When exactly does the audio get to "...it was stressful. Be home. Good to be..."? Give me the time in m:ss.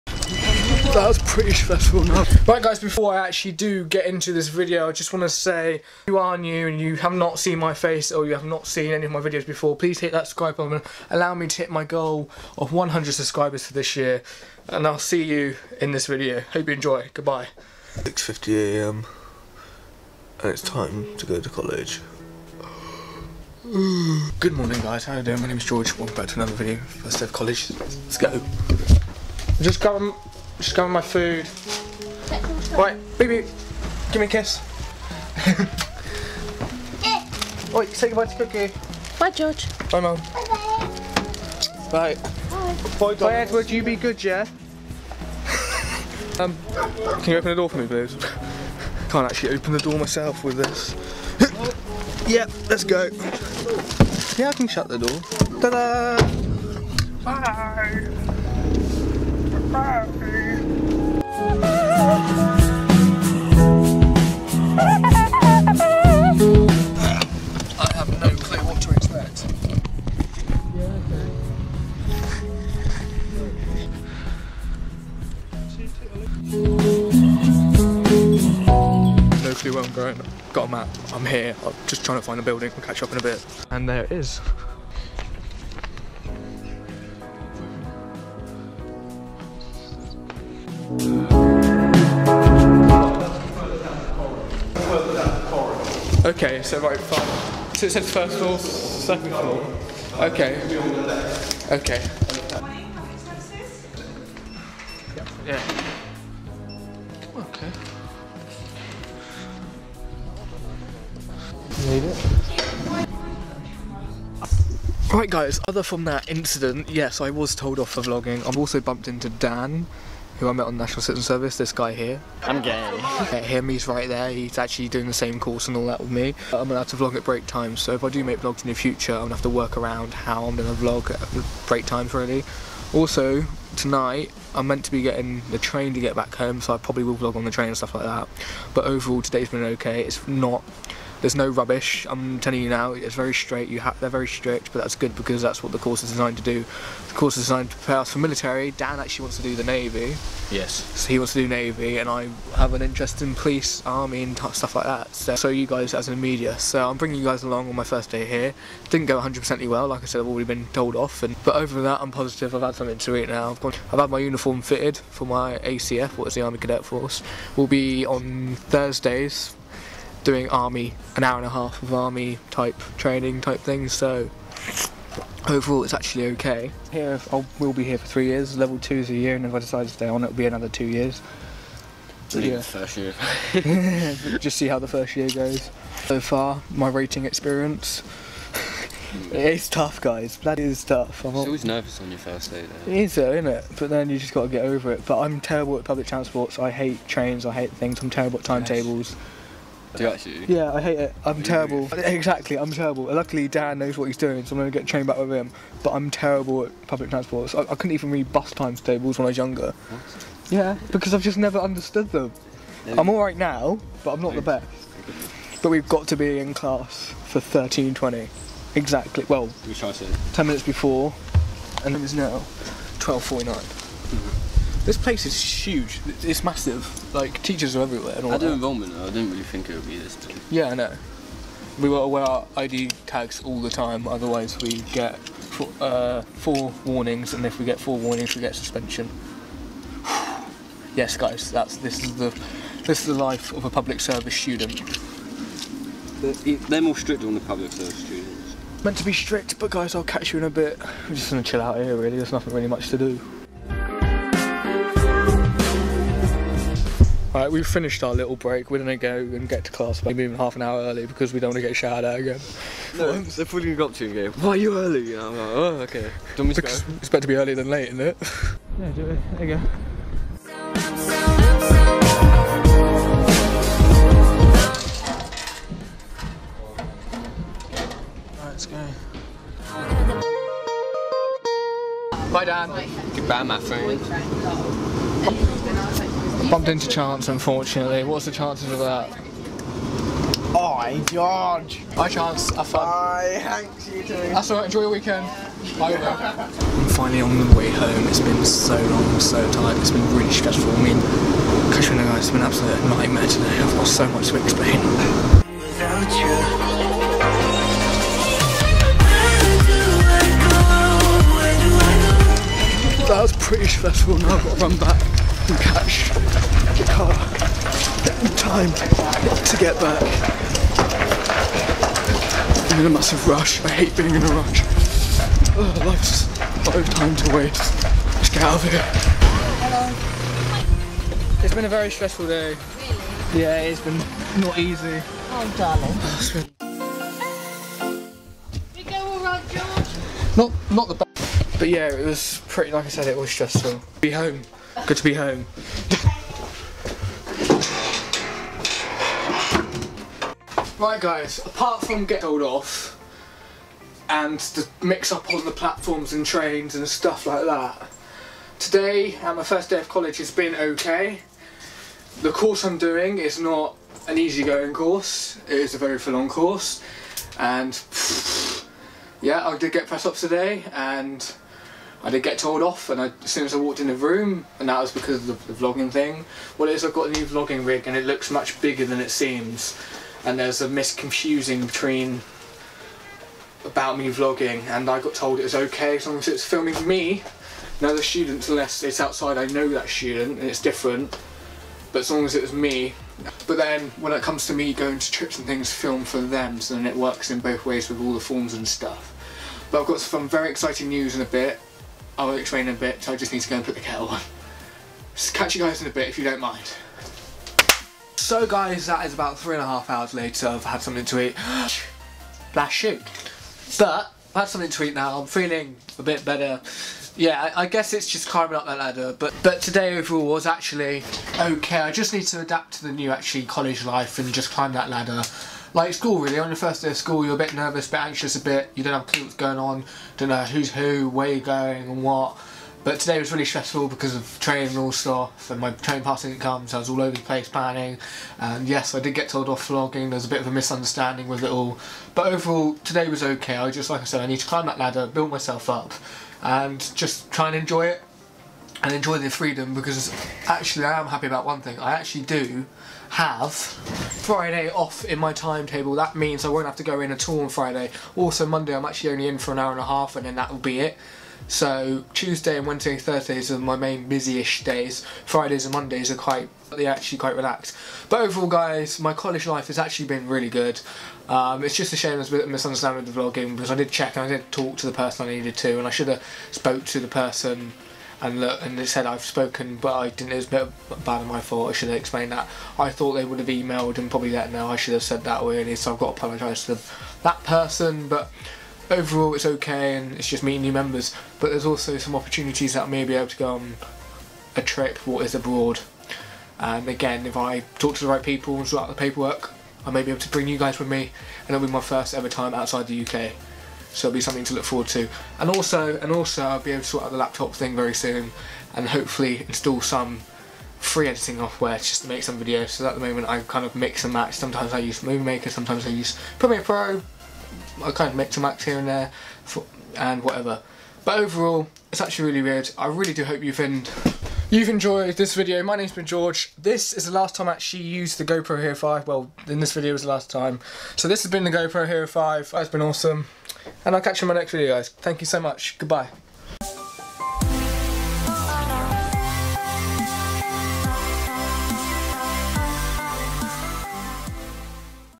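5:43.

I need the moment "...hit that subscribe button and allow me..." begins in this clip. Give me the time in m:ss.
0:09.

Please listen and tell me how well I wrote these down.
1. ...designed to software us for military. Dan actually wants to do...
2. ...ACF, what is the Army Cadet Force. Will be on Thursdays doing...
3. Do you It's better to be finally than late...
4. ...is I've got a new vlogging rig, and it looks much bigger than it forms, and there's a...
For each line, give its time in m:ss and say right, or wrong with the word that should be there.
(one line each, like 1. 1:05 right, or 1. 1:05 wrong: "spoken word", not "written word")
1. 2:27 wrong: "prepare", not "software"
2. 2:45 right
3. 4:26 wrong: "early", not "finally"
4. 6:16 wrong: "seems", not "forms".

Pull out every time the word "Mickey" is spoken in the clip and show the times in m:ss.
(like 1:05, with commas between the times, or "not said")
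not said.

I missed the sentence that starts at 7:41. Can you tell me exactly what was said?
So Tuesday and Wednesday and Thursdays are my main busy-ish days.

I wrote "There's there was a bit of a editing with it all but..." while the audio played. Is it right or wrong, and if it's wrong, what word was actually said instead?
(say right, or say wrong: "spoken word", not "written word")
wrong: "misunderstanding", not "editing".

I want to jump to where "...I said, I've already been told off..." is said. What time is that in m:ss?
2:40.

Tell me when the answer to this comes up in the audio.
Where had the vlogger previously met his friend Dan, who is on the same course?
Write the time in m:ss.
2:00.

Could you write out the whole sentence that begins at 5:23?
I hate being in a rush.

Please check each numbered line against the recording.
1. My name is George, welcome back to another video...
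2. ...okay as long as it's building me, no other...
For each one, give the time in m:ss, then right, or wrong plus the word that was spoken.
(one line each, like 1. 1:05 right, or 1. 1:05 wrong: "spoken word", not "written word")
1. 0:25 right
2. 6:25 wrong: "filming", not "building".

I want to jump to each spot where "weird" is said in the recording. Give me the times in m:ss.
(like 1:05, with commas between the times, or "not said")
8:42.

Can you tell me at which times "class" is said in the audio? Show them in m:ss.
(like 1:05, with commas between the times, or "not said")
3:36, 4:19.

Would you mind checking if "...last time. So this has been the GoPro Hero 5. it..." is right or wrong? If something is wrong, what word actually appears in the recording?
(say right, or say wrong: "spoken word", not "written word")
right.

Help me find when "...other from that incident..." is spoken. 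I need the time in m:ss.
1:55.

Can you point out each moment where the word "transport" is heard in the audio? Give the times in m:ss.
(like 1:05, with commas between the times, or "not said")
3:16, 3:27.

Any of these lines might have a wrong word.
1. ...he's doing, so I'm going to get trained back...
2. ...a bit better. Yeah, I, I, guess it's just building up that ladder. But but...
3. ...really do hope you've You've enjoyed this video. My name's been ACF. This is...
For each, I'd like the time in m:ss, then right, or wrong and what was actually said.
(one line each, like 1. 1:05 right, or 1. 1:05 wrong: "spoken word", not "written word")
1. 3:24 right
2. 6:55 wrong: "climbing", not "building"
3. 8:42 wrong: "George", not "ACF".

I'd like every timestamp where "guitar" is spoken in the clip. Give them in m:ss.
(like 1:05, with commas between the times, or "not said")
not said.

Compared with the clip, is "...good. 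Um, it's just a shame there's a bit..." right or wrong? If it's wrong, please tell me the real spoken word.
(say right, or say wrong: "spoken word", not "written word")
right.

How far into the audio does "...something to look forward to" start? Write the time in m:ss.
8:24.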